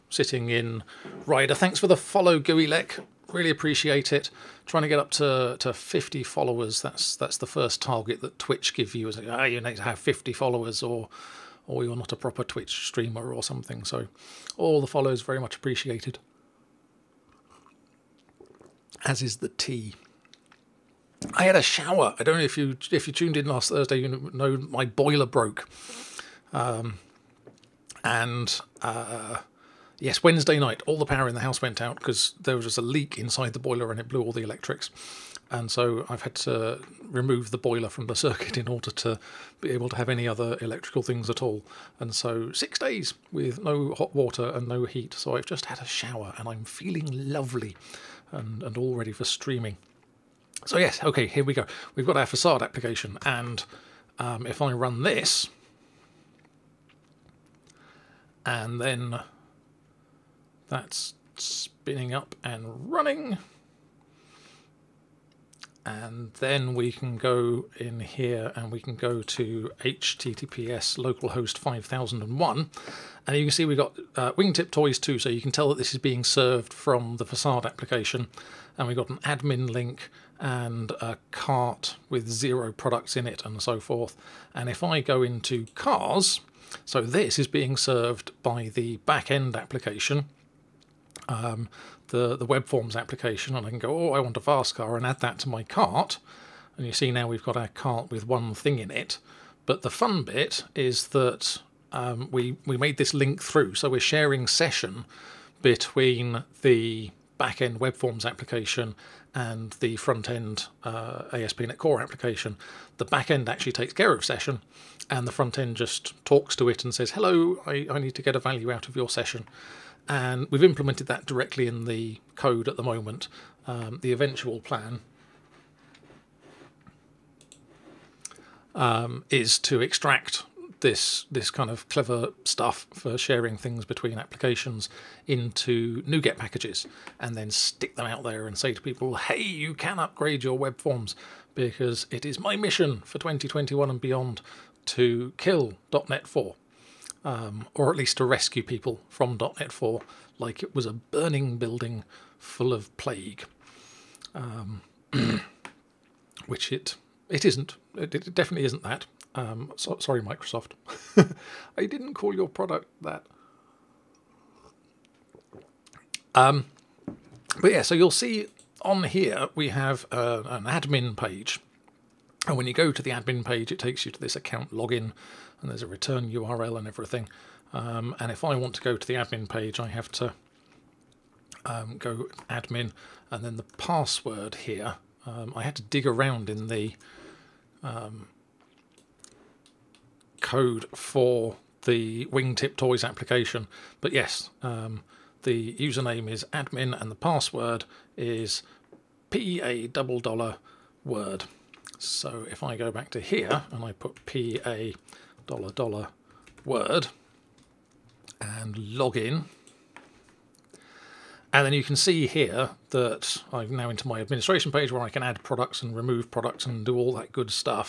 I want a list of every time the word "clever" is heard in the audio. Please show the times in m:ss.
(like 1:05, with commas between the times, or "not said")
2:11.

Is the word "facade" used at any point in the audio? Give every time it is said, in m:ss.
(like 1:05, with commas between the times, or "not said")
0:52, 1:17.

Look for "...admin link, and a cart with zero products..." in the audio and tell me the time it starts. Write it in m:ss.
1:19.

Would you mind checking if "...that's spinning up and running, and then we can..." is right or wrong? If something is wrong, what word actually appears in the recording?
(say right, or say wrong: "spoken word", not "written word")
right.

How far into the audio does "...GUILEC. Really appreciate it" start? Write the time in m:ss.
0:02.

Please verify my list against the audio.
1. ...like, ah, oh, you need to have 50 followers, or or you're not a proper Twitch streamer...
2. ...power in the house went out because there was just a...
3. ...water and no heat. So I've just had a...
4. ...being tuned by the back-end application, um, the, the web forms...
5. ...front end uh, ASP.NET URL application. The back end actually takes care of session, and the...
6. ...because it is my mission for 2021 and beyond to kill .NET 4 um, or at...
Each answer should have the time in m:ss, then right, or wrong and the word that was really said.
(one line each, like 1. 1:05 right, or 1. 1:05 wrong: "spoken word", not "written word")
1. 0:09 right
2. 0:31 right
3. 0:44 right
4. 1:27 wrong: "served", not "tuned"
5. 1:49 wrong: "Core", not "URL"
6. 2:21 right.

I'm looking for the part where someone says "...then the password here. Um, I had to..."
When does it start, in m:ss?
3:03.